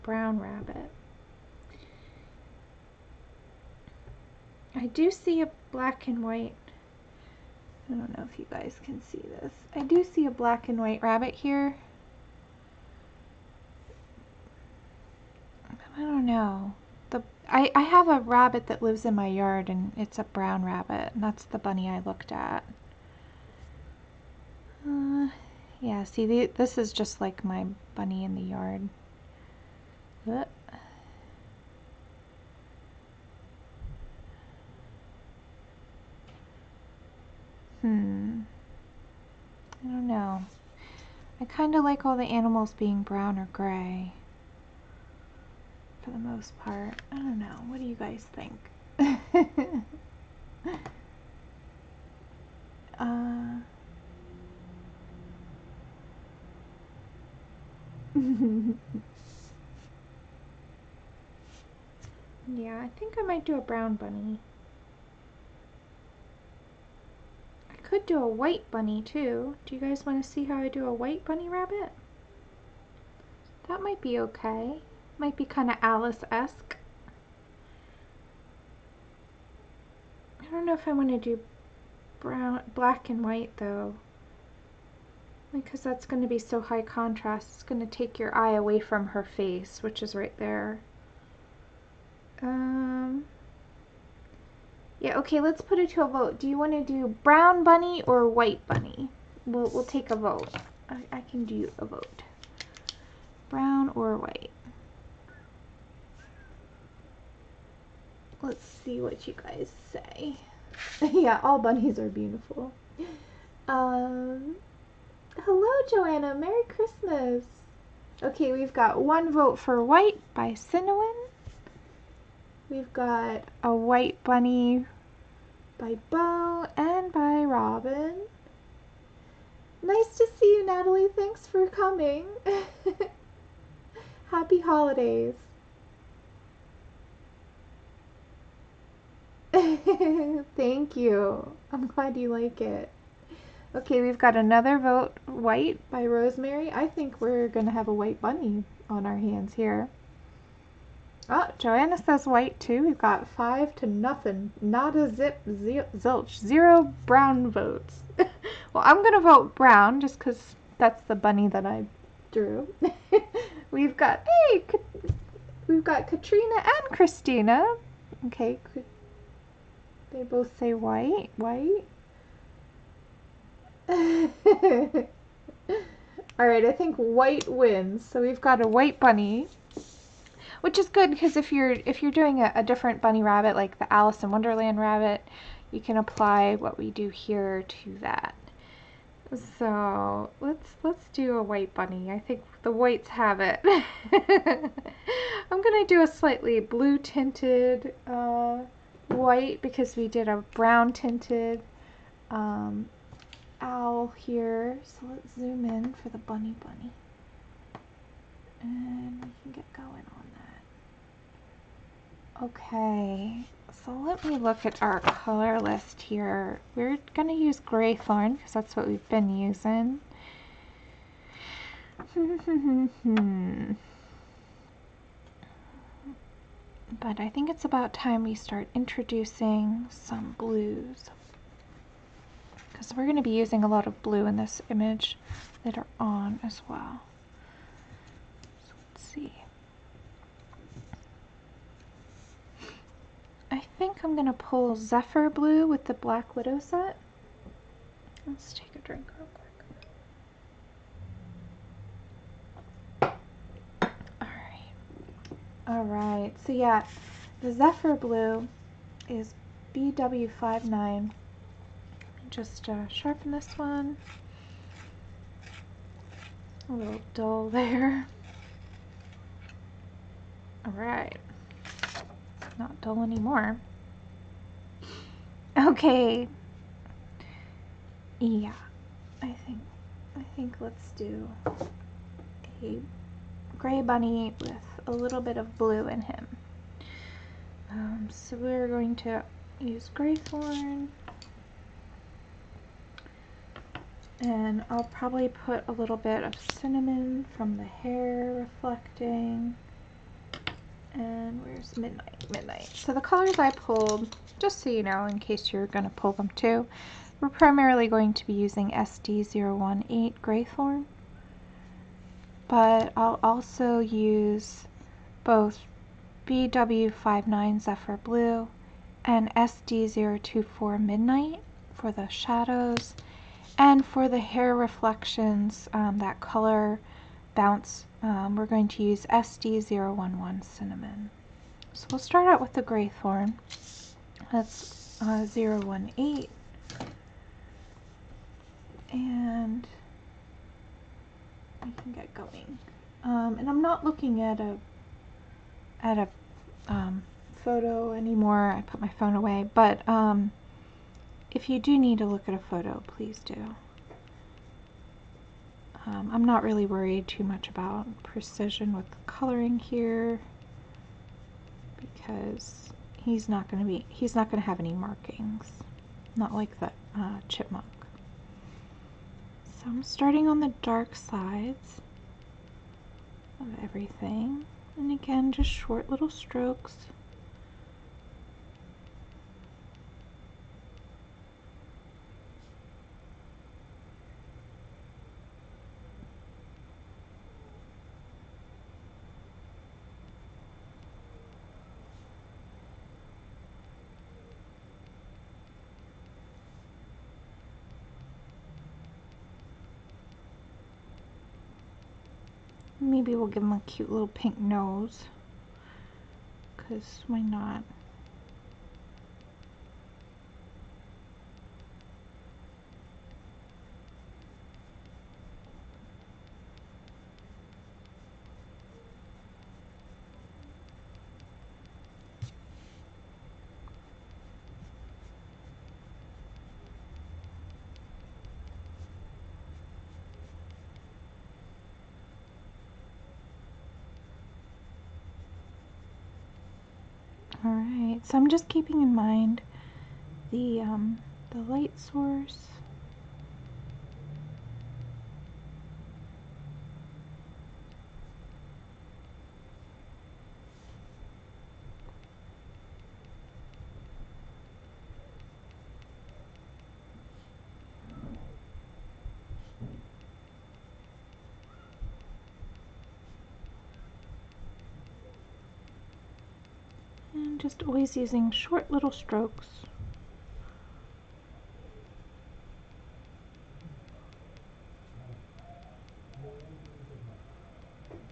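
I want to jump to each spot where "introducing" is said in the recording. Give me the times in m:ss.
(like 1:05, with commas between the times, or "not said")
3:48.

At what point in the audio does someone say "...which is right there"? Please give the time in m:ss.
1:29.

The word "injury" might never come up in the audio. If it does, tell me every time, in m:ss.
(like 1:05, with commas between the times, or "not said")
not said.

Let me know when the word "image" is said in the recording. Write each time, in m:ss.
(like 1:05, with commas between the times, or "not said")
3:54.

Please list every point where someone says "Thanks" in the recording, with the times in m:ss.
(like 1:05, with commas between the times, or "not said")
2:11, 2:19.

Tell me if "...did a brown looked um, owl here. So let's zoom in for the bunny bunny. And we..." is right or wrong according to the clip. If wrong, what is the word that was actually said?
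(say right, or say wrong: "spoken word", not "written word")
wrong: "tinted", not "looked".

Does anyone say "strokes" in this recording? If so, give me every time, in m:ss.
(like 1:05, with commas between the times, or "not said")
6:16, 7:48.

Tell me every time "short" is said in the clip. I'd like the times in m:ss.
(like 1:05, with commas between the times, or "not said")
6:15, 7:48.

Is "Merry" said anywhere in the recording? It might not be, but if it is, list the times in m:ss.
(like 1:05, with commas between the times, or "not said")
1:56.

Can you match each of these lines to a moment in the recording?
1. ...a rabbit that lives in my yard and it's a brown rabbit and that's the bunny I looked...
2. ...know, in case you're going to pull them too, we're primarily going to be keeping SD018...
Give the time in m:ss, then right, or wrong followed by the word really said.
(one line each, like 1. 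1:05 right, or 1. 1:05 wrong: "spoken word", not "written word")
1. 0:18 right
2. 5:04 wrong: "using", not "keeping".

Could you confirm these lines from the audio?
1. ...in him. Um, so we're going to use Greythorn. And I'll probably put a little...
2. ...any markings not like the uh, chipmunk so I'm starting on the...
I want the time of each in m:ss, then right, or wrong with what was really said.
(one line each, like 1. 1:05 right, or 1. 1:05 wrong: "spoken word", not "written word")
1. 4:45 right
2. 6:04 right.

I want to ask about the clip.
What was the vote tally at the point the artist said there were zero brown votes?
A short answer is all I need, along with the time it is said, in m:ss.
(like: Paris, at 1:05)
5 to 0, at 2:33.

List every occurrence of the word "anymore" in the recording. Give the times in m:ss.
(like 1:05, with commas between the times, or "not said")
4:33, 5:47.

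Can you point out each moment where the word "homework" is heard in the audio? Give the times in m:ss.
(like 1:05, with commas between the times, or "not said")
not said.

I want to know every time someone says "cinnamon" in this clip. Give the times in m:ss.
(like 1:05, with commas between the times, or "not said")
2:00, 4:56, 5:30.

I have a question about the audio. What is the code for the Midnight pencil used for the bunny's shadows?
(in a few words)
SD024.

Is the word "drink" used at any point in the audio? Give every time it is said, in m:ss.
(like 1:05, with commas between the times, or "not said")
4:08.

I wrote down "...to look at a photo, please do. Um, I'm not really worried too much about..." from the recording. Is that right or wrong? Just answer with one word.
right.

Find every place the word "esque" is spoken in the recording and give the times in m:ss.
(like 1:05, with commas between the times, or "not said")
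1:15.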